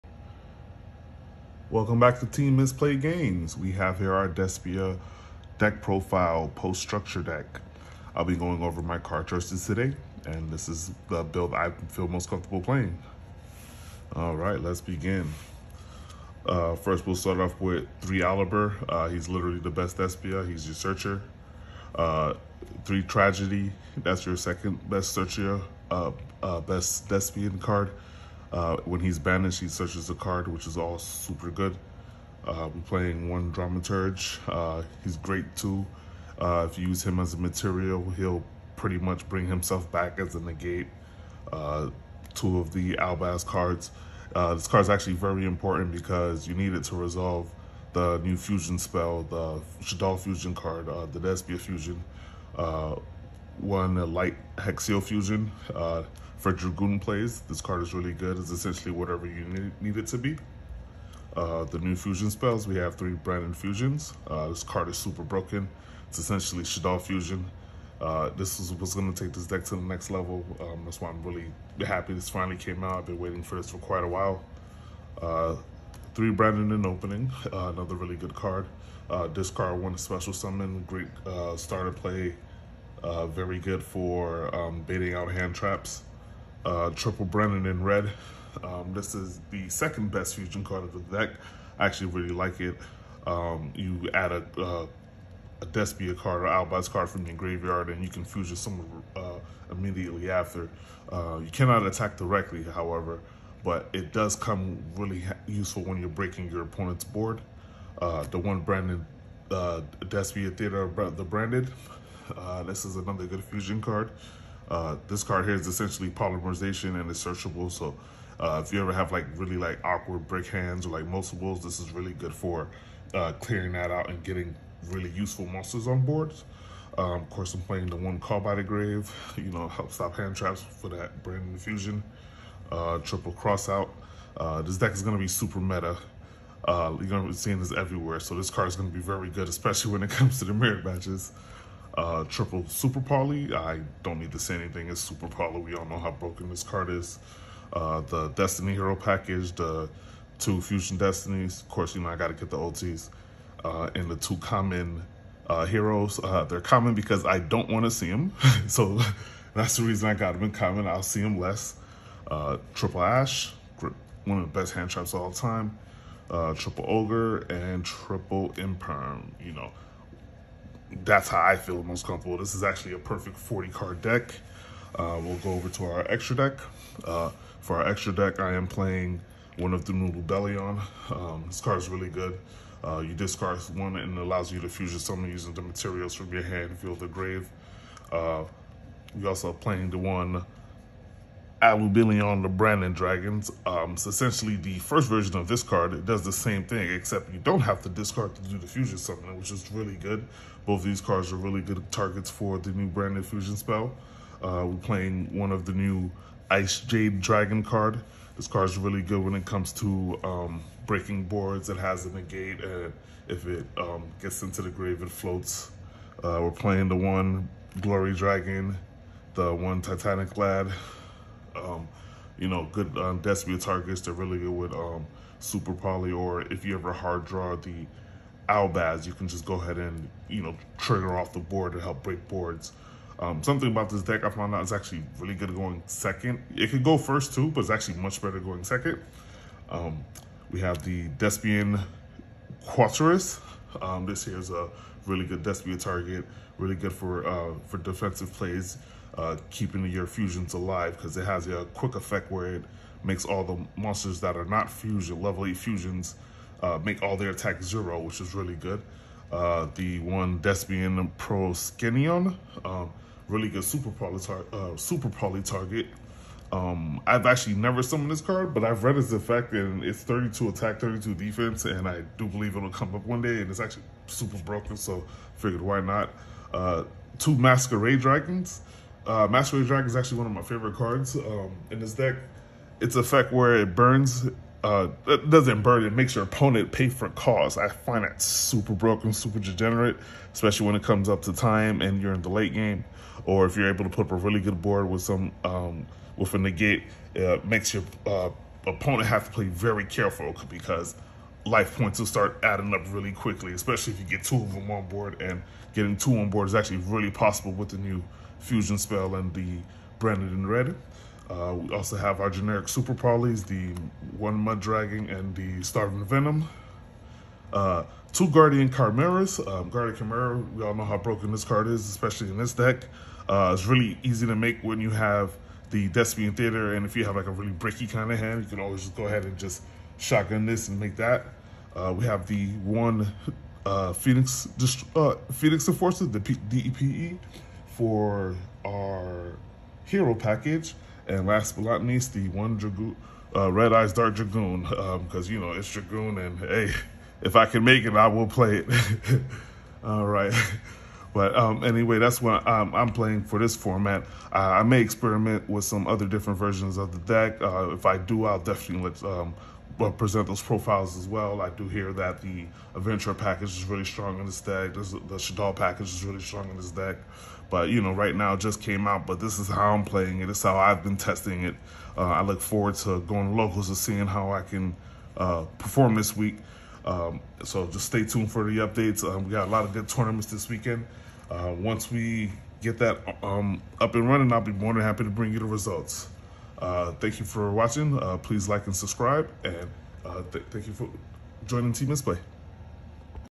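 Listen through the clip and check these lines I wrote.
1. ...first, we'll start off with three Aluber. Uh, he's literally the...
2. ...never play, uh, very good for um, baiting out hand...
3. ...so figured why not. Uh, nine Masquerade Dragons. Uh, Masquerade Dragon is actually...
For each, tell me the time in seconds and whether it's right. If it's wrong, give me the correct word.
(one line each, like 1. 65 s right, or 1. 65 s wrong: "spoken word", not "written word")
1. 16 s right
2. 81 s wrong: "starter", not "never"
3. 274 s wrong: "two", not "nine".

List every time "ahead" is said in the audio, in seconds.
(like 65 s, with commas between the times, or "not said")
229 s, 329 s.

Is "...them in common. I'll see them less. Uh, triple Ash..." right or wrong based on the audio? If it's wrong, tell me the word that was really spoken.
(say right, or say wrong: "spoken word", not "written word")
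right.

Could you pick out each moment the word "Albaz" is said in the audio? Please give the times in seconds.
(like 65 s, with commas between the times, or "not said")
42 s, 96 s, 228 s.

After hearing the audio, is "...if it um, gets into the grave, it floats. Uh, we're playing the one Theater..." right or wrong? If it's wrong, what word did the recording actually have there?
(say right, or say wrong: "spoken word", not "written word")
wrong: "Glory", not "Theater".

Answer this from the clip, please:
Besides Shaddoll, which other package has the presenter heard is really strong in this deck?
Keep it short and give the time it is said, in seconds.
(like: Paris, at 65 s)
Adventure package, at 362 s.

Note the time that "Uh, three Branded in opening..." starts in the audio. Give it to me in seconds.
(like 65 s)
75 s.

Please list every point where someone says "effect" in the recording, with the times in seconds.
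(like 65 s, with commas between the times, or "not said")
251 s, 269 s, 282 s.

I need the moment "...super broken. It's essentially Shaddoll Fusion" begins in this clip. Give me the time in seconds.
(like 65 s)
64 s.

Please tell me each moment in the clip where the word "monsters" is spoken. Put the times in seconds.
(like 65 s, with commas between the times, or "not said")
125 s, 253 s.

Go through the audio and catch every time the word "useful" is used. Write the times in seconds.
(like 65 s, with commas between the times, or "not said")
105 s, 125 s.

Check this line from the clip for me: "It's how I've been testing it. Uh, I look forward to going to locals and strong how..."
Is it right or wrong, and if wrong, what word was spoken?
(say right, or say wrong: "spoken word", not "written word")
wrong: "seeing", not "strong".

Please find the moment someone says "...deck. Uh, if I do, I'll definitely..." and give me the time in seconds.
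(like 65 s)
356 s.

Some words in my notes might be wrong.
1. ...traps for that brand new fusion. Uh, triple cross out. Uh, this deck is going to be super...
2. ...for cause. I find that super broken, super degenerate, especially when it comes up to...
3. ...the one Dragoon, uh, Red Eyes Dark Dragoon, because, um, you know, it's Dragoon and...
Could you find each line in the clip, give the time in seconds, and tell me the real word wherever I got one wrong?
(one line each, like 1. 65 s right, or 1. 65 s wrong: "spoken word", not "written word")
1. 130 s right
2. 286 s right
3. 342 s right.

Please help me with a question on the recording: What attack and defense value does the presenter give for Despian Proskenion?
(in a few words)
3200.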